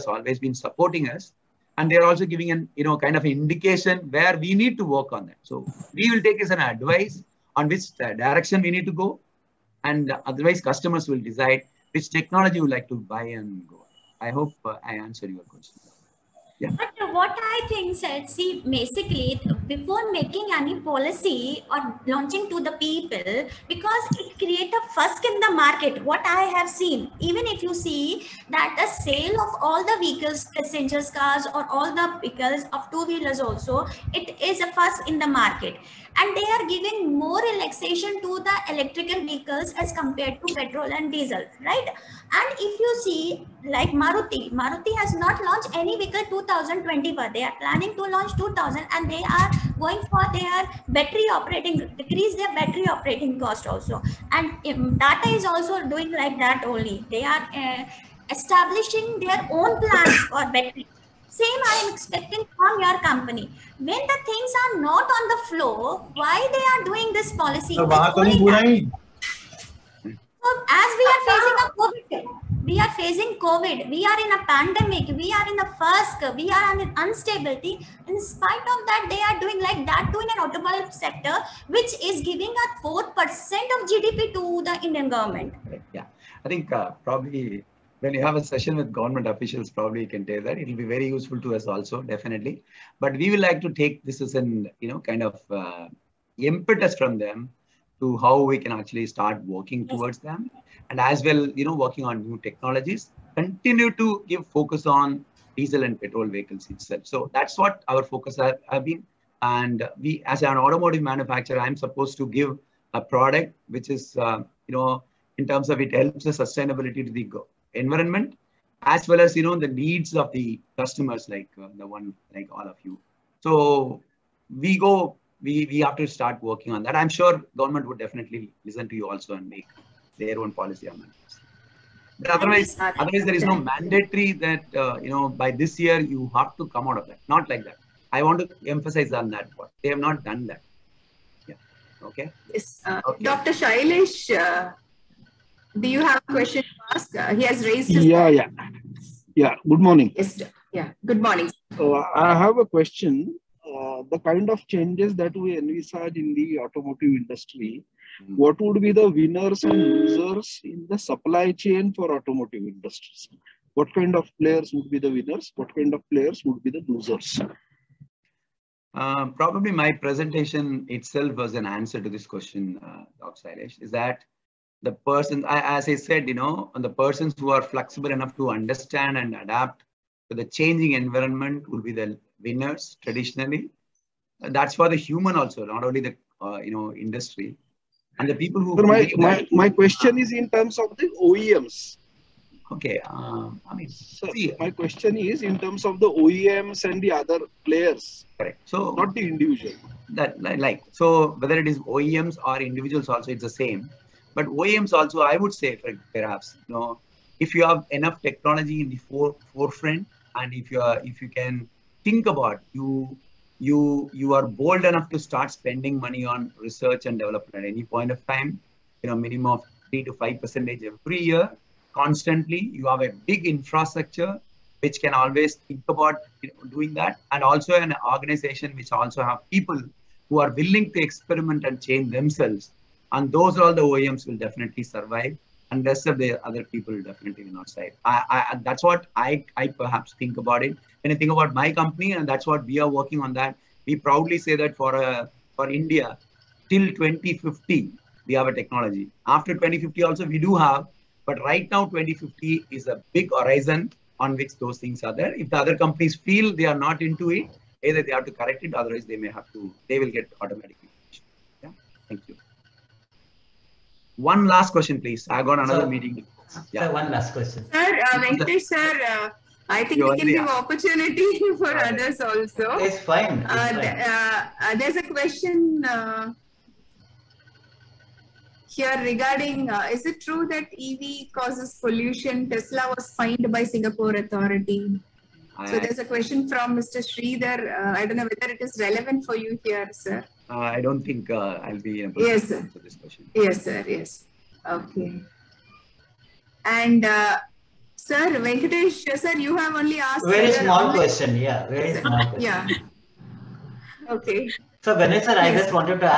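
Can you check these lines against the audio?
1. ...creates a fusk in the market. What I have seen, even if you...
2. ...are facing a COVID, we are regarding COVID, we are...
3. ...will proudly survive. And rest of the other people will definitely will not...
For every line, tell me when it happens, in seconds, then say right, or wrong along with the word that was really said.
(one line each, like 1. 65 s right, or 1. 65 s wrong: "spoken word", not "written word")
1. 24 s right
2. 71 s wrong: "facing", not "regarding"
3. 234 s wrong: "definitely", not "proudly".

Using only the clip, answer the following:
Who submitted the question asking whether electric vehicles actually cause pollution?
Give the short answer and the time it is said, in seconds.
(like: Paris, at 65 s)
Mr. Sridhar, at 286 s.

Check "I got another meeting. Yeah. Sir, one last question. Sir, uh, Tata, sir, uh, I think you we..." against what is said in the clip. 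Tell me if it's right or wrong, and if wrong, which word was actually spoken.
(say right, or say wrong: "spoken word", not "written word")
wrong: "Venkatesh", not "Tata".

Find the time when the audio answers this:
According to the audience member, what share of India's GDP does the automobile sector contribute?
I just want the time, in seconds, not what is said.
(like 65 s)
82 s.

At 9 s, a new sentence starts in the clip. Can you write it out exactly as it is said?
And otherwise, customers will decide which technology you like to buy and go.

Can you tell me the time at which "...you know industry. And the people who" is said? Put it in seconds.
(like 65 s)
186 s.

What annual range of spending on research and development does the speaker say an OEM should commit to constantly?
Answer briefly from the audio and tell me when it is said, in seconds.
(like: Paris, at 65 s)
3 to 5 percent, at 219 s.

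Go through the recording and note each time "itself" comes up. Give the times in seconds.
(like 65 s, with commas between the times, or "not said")
106 s, 170 s.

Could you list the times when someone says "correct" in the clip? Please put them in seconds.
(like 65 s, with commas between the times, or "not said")
198 s, 258 s.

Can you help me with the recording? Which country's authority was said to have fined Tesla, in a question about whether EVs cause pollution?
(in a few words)
Singapore.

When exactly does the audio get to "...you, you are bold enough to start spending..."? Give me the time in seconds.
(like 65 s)
213 s.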